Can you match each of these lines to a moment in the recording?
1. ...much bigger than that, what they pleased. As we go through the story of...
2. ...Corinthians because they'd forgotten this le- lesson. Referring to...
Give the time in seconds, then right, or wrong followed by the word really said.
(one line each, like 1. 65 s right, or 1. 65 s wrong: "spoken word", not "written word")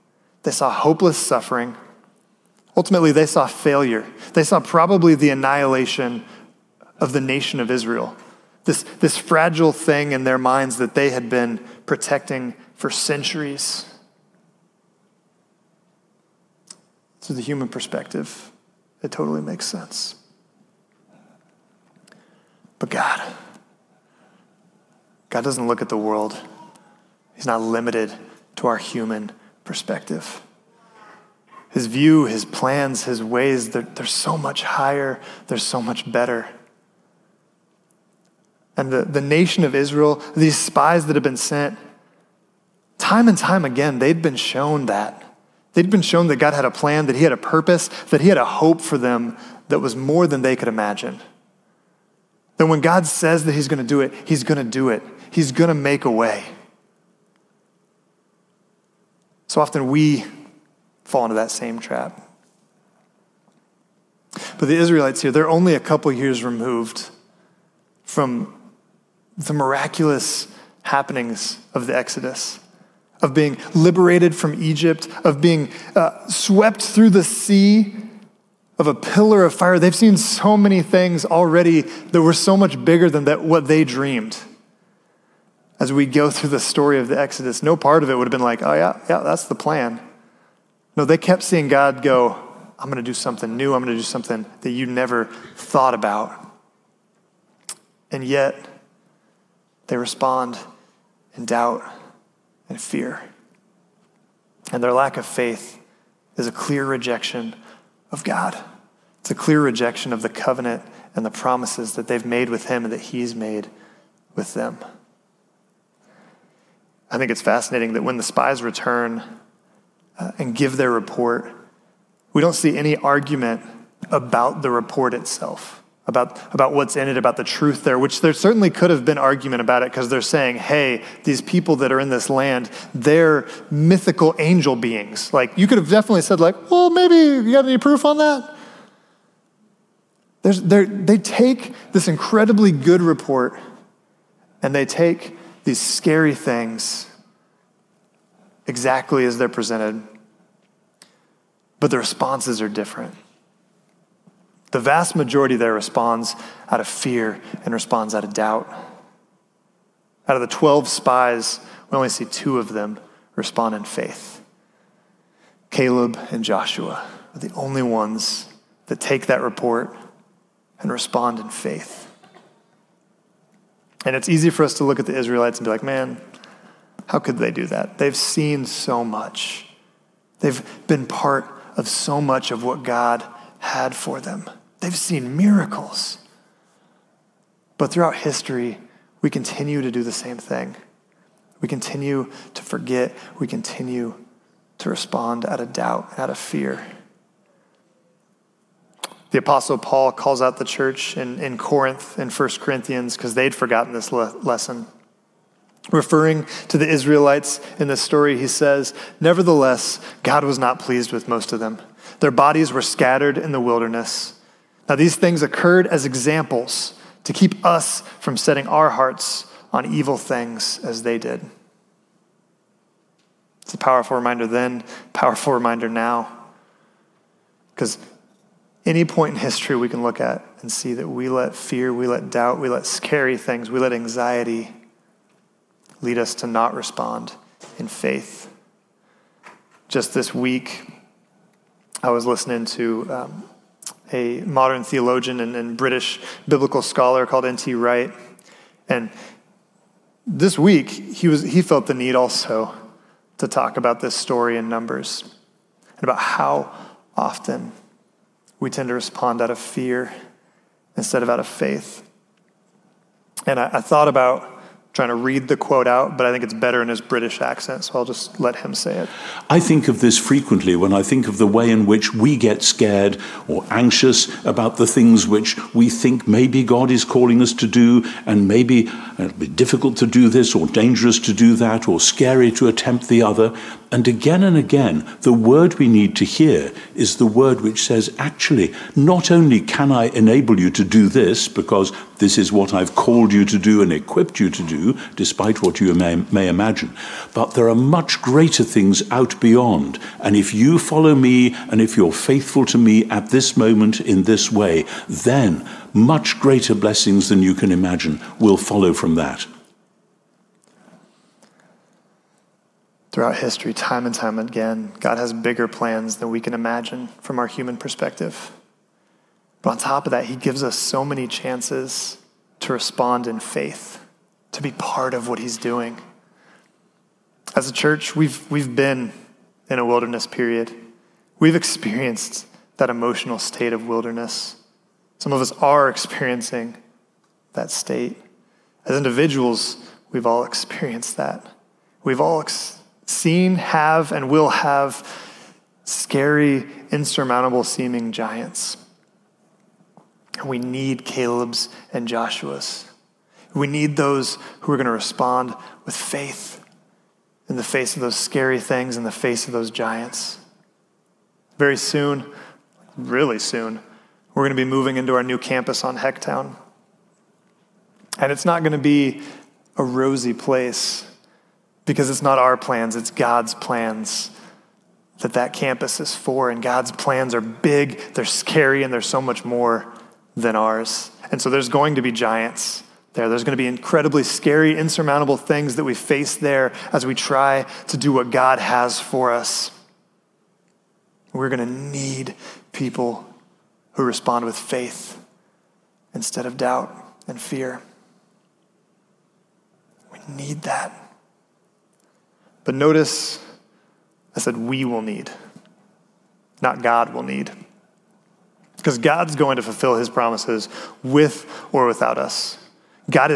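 1. 82 s wrong: "dreamed", not "pleased"
2. 202 s right.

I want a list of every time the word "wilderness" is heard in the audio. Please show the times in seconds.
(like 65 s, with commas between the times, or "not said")
213 s, 329 s, 333 s.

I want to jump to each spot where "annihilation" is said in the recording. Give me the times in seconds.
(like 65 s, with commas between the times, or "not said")
5 s.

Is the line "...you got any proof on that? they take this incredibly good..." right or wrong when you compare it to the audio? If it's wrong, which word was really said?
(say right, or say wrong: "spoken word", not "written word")
right.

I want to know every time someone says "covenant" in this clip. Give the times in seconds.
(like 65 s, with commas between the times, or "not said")
110 s.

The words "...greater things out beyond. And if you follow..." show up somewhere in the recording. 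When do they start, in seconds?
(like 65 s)
298 s.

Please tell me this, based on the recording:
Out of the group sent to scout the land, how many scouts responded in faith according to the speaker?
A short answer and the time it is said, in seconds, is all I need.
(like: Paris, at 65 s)
2, at 162 s.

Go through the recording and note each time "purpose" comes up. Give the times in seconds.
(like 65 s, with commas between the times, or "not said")
47 s.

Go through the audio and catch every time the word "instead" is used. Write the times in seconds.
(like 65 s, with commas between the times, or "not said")
260 s, 396 s.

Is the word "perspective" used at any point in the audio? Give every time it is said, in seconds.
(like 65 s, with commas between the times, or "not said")
17 s, 29 s, 317 s.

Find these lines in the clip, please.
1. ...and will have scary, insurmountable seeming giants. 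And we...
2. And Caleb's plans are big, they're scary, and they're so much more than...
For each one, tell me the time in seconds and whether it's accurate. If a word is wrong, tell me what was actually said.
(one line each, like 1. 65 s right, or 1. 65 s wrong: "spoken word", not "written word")
1. 344 s right
2. 376 s wrong: "God", not "Caleb".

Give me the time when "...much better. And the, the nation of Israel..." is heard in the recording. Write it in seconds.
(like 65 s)
35 s.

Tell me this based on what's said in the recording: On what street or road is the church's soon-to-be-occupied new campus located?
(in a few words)
Hecktown.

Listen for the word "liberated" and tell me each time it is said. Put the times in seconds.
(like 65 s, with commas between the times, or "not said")
73 s.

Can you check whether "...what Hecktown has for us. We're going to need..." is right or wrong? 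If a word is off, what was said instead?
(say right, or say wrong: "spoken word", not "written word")
wrong: "God", not "Hecktown".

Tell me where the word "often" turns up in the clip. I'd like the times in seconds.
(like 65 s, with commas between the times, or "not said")
59 s, 257 s.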